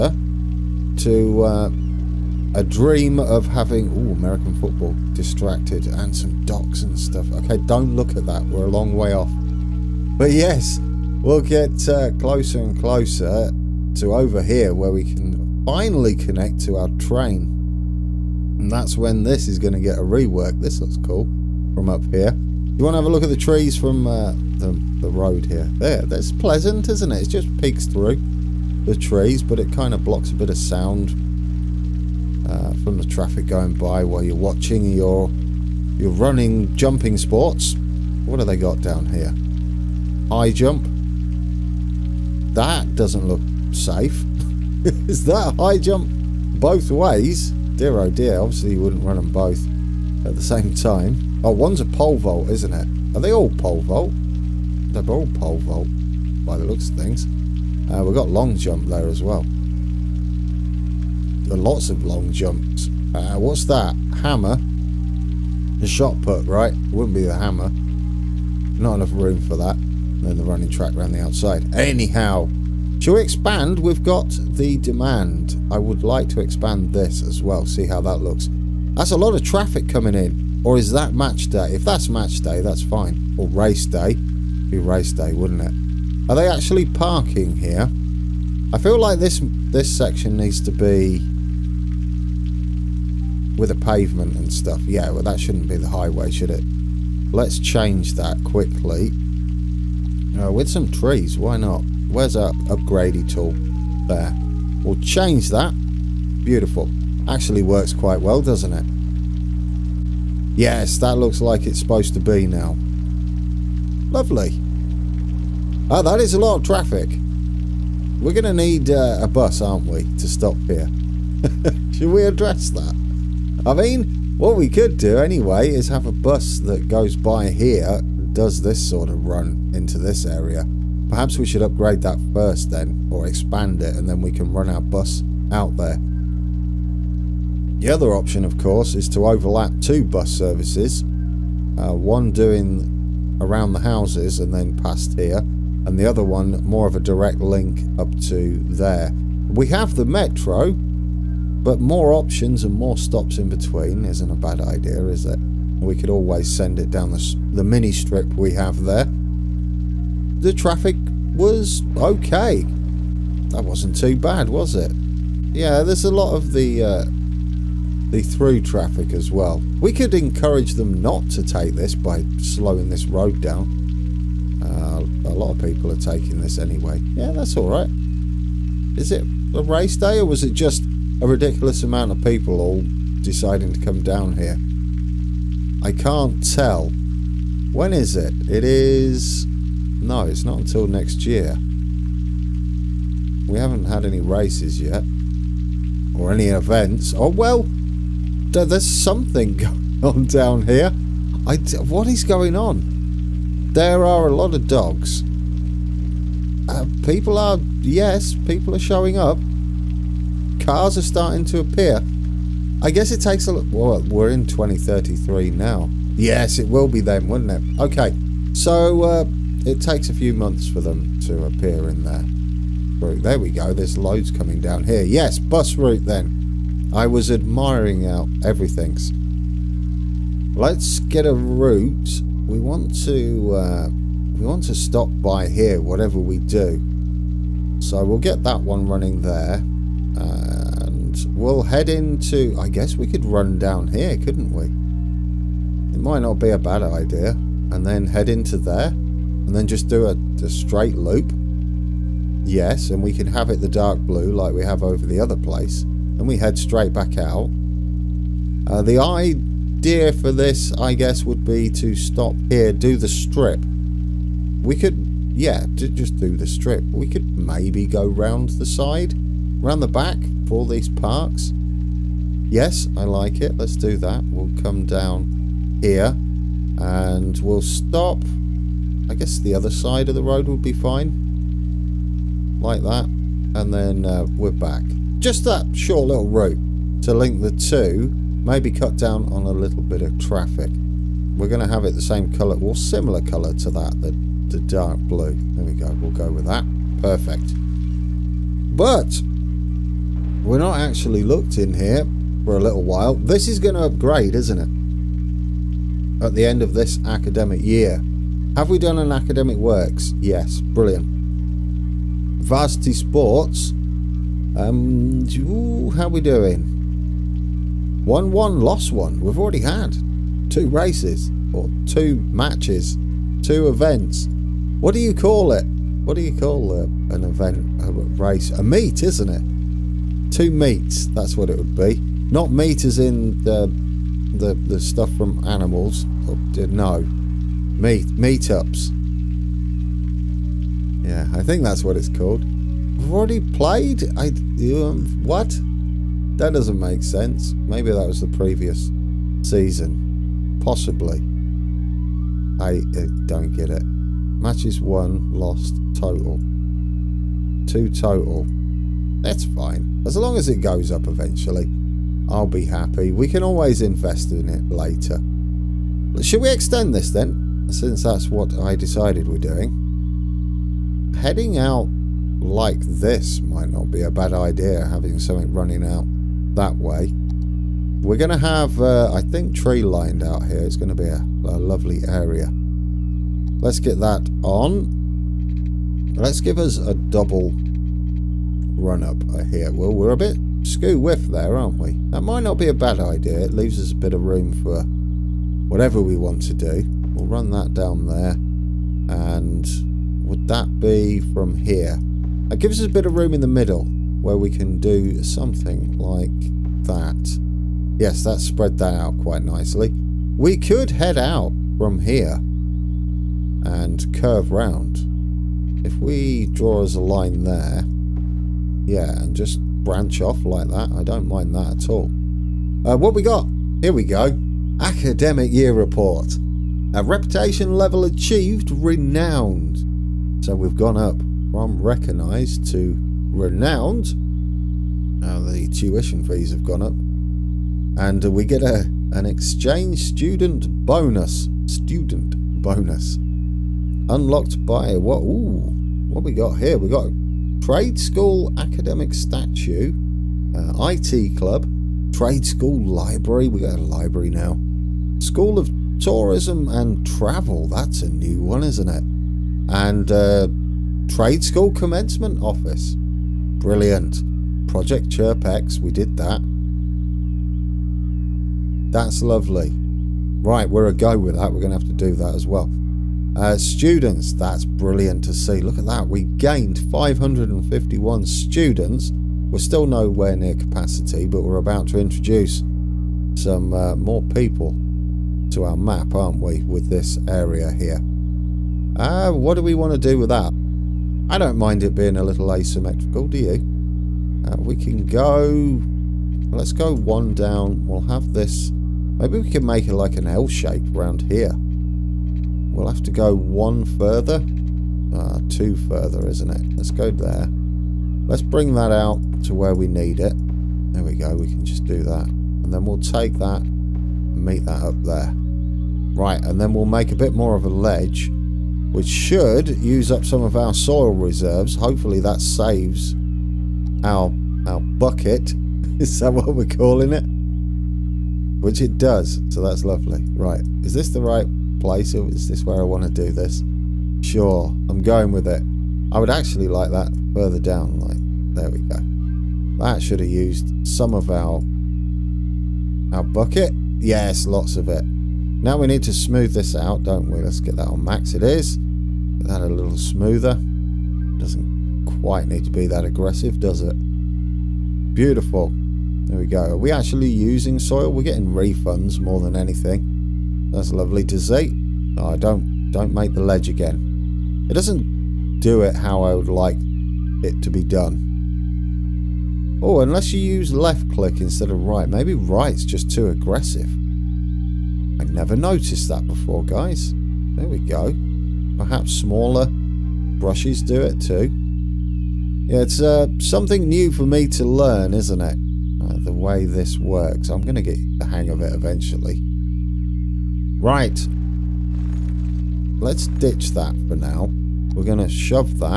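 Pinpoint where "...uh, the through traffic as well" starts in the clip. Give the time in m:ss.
2:46.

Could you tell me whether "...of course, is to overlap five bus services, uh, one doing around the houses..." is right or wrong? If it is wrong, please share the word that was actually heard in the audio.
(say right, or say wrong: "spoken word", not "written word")
wrong: "two", not "five".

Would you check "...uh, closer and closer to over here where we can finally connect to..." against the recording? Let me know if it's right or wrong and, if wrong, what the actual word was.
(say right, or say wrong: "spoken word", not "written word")
right.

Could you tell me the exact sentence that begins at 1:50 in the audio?
Yes, that looks like it's supposed to be now.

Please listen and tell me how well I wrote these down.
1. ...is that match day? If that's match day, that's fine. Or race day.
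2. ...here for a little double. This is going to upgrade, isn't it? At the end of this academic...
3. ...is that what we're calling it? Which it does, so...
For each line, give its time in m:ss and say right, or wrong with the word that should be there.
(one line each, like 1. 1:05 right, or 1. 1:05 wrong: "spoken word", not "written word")
1. 1:20 right
2. 5:01 wrong: "while", not "double"
3. 8:45 right.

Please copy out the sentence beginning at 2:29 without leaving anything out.
We have the metro, but more options and more stops in between isn't a bad idea, is it?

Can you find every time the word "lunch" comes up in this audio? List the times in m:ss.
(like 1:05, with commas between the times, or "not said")
not said.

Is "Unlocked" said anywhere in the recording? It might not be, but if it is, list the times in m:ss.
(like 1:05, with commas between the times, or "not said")
7:24.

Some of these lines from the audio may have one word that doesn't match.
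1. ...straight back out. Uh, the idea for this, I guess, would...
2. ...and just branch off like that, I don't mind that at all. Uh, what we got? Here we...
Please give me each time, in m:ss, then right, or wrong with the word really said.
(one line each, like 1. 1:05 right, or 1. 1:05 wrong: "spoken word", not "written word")
1. 4:16 right
2. 6:59 right.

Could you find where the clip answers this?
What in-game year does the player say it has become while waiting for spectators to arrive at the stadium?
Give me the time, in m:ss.
3:34.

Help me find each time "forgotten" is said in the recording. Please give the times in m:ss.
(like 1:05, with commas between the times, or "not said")
not said.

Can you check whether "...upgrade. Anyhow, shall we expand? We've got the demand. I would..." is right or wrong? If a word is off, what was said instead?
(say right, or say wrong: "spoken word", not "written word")
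wrong: "outside", not "upgrade".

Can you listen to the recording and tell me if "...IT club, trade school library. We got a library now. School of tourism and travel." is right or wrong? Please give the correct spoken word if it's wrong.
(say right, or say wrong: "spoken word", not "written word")
right.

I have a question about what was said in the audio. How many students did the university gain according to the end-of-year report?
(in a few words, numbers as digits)
551.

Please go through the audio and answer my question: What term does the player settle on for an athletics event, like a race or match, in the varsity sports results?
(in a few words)
A meet.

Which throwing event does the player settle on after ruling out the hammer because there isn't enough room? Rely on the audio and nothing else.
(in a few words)
Shot put.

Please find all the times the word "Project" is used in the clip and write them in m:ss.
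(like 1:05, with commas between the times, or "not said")
7:44.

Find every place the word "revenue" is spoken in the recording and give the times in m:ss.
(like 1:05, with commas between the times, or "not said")
not said.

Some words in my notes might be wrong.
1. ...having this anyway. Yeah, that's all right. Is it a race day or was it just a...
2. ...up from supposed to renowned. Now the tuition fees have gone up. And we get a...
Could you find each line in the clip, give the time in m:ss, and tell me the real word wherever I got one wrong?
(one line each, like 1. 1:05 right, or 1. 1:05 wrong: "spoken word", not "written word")
1. 2:55 wrong: "taking", not "having"
2. 7:10 wrong: "recognised", not "supposed".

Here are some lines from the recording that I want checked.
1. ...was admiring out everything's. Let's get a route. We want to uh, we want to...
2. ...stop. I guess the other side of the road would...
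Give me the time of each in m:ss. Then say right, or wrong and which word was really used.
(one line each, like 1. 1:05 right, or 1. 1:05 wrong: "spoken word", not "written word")
1. 3:47 right
2. 4:37 right.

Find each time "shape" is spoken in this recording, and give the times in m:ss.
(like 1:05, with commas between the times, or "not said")
8:20.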